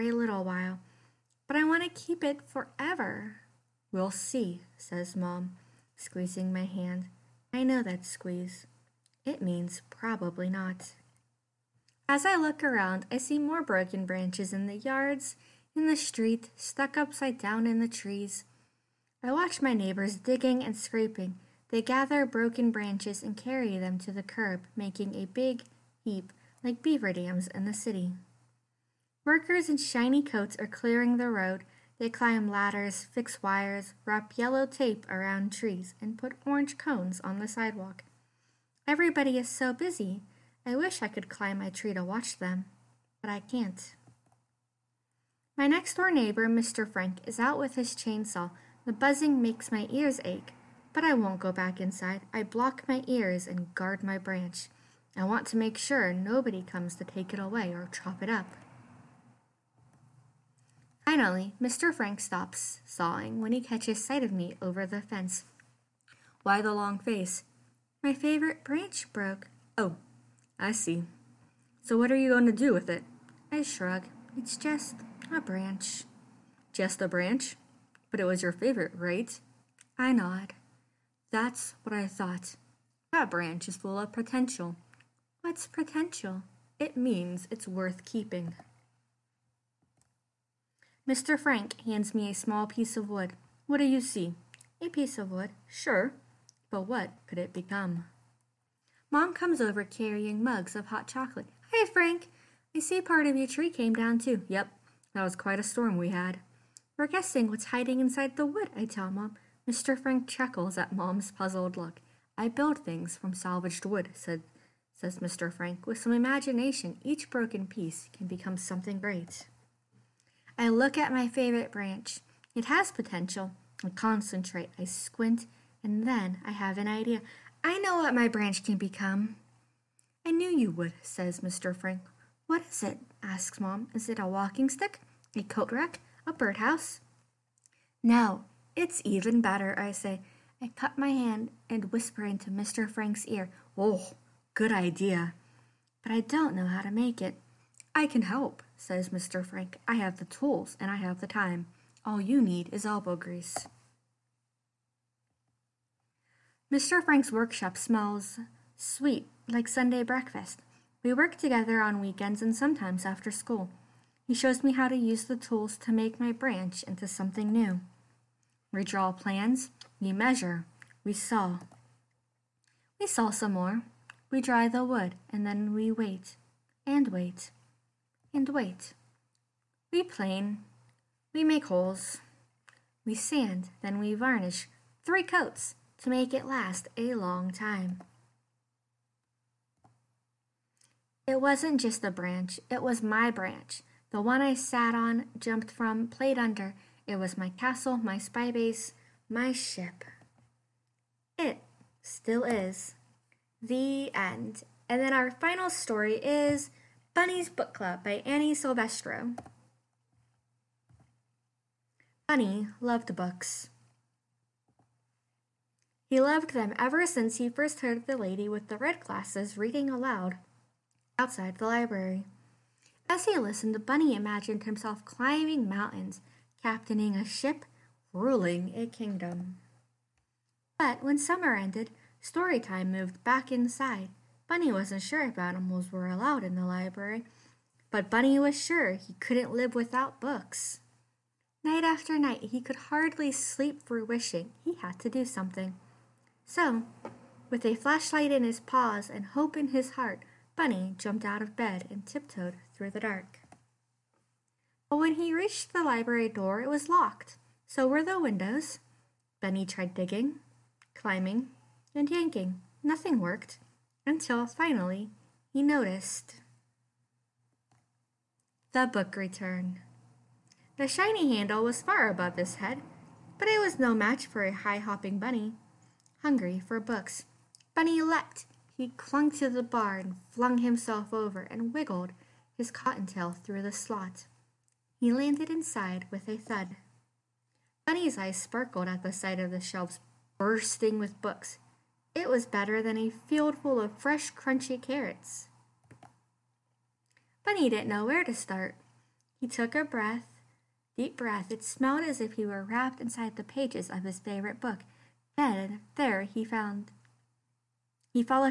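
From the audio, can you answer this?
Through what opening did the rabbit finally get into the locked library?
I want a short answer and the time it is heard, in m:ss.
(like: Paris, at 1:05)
The book return, at 4:28.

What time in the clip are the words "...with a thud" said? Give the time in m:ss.
4:46.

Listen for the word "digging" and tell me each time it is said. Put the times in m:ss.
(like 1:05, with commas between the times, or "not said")
0:20, 4:19.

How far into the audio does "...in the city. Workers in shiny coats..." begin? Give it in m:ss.
0:27.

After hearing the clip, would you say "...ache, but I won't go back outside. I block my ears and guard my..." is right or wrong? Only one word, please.
wrong.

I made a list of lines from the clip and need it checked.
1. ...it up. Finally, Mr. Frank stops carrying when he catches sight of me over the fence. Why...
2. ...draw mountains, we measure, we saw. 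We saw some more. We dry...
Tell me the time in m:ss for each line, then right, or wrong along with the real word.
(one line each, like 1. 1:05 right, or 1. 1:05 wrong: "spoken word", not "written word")
1. 0:58 wrong: "sawing", not "carrying"
2. 2:48 wrong: "plans", not "mountains".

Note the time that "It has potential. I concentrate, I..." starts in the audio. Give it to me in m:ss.
2:02.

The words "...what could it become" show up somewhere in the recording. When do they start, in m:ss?
1:36.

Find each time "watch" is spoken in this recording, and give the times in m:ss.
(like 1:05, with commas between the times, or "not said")
0:19, 0:42.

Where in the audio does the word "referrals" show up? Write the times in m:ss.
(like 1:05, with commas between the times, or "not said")
not said.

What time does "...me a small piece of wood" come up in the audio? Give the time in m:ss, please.
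1:32.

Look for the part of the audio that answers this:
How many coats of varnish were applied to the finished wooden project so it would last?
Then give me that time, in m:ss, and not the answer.
3:05.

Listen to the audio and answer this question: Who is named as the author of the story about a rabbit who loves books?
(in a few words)
Annie Silvestro.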